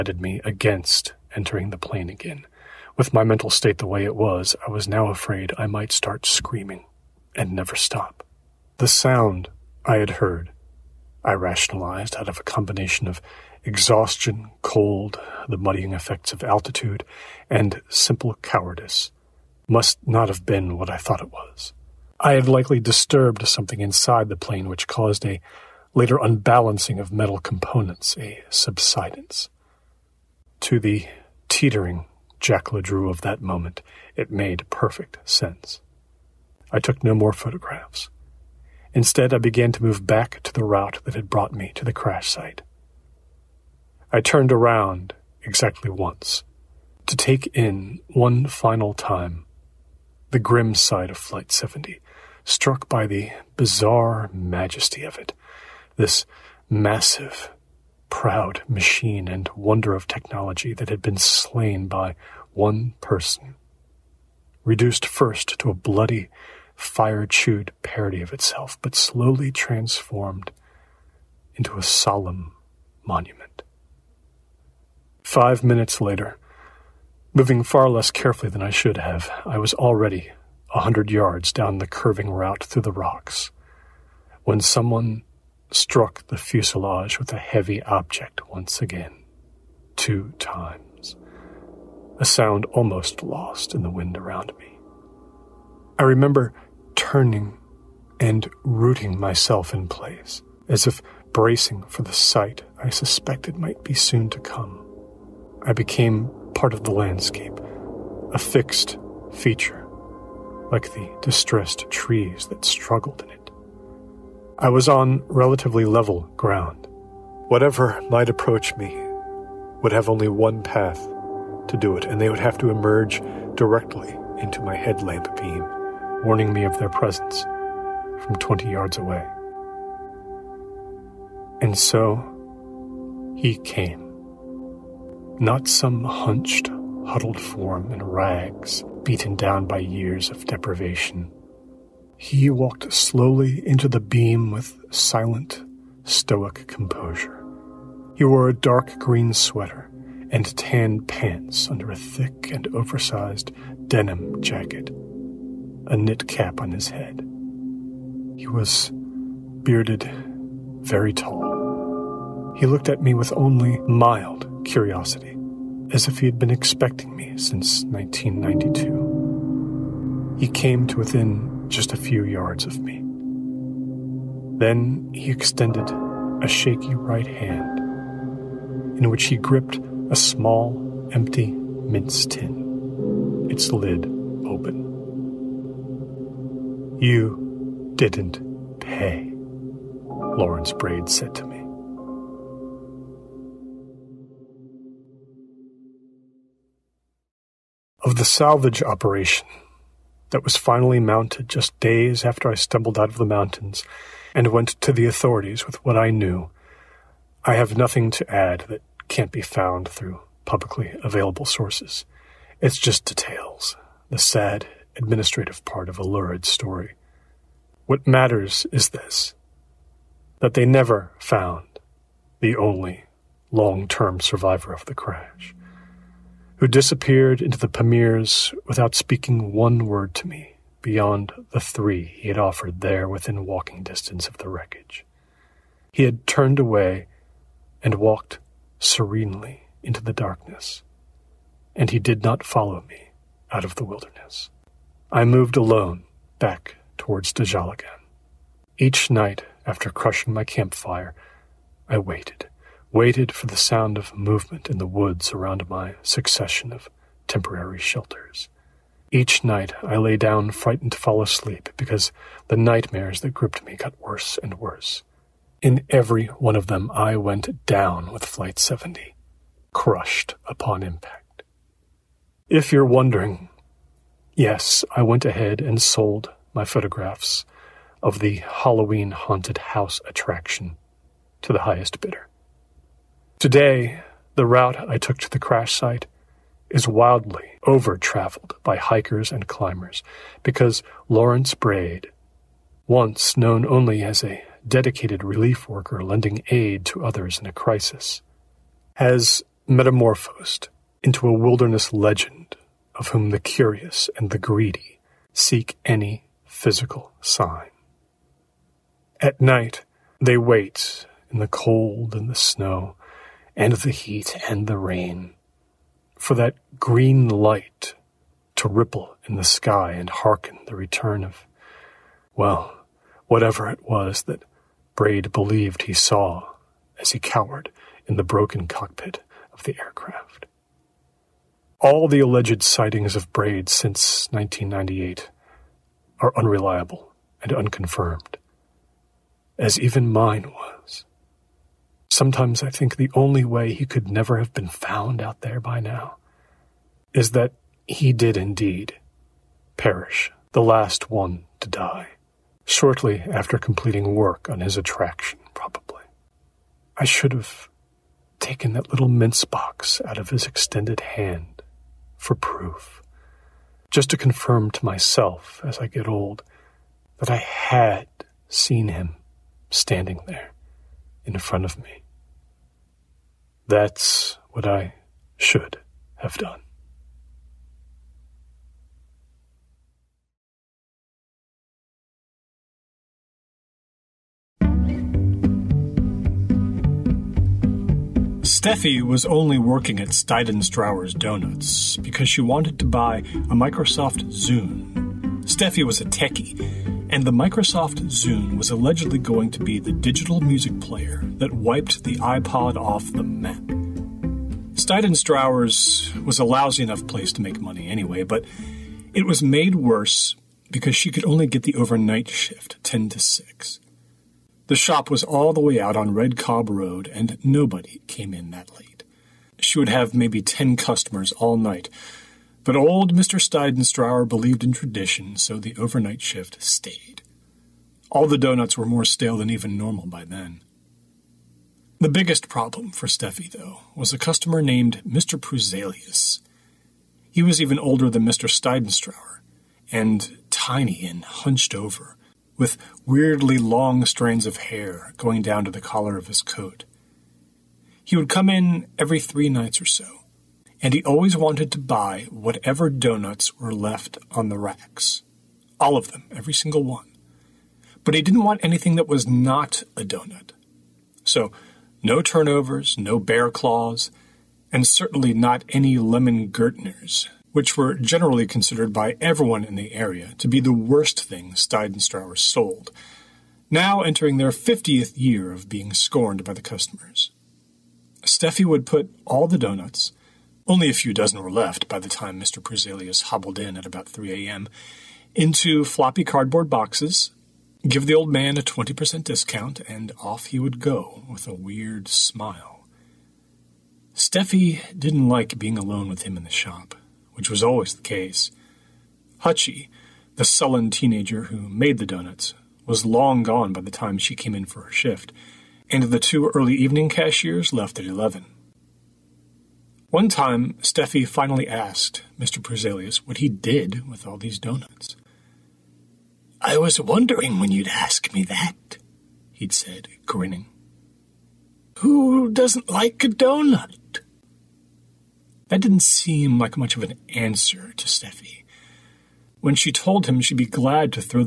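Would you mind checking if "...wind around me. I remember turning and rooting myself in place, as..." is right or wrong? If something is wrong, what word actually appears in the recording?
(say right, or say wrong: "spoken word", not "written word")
right.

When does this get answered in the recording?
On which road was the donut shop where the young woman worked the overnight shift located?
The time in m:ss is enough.
6:56.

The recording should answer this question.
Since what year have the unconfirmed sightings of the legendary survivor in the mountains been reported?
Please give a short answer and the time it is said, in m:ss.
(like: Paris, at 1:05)
1998, at 5:34.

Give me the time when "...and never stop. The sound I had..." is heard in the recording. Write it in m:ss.
0:07.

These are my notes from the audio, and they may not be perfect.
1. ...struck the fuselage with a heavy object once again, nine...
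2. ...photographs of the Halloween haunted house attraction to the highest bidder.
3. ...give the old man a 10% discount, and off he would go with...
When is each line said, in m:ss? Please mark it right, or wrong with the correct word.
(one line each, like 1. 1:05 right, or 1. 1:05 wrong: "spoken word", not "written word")
1. 1:25 wrong: "two", not "nine"
2. 4:36 right
3. 8:07 wrong: "20", not "10".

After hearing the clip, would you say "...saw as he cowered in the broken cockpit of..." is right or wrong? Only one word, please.
right.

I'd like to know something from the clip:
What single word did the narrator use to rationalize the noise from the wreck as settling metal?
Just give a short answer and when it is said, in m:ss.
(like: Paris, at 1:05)
subsidence, at 0:28.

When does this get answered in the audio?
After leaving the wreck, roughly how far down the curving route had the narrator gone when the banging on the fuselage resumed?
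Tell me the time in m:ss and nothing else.
1:20.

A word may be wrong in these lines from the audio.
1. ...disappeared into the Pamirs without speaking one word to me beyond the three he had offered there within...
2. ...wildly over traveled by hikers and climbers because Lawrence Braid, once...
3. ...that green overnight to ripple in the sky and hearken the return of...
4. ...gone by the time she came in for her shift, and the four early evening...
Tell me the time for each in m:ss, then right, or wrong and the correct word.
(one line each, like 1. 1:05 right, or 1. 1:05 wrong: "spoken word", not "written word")
1. 3:46 right
2. 4:46 right
3. 5:16 wrong: "light", not "overnight"
4. 8:23 wrong: "two", not "four".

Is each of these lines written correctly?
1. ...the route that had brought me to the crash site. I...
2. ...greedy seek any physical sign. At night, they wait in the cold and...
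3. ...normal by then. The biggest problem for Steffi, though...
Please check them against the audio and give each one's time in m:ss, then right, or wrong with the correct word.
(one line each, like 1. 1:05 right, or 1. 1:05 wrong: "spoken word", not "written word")
1. 0:40 right
2. 5:04 right
3. 7:09 right.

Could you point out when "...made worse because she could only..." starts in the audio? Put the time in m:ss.
6:49.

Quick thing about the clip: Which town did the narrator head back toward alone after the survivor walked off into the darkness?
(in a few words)
Dajjal.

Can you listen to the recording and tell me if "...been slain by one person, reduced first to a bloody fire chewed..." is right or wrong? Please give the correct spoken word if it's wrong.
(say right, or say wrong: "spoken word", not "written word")
right.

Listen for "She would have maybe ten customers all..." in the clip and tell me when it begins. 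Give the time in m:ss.
6:59.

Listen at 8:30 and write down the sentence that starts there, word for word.
One time, Steffi finally asked Mr.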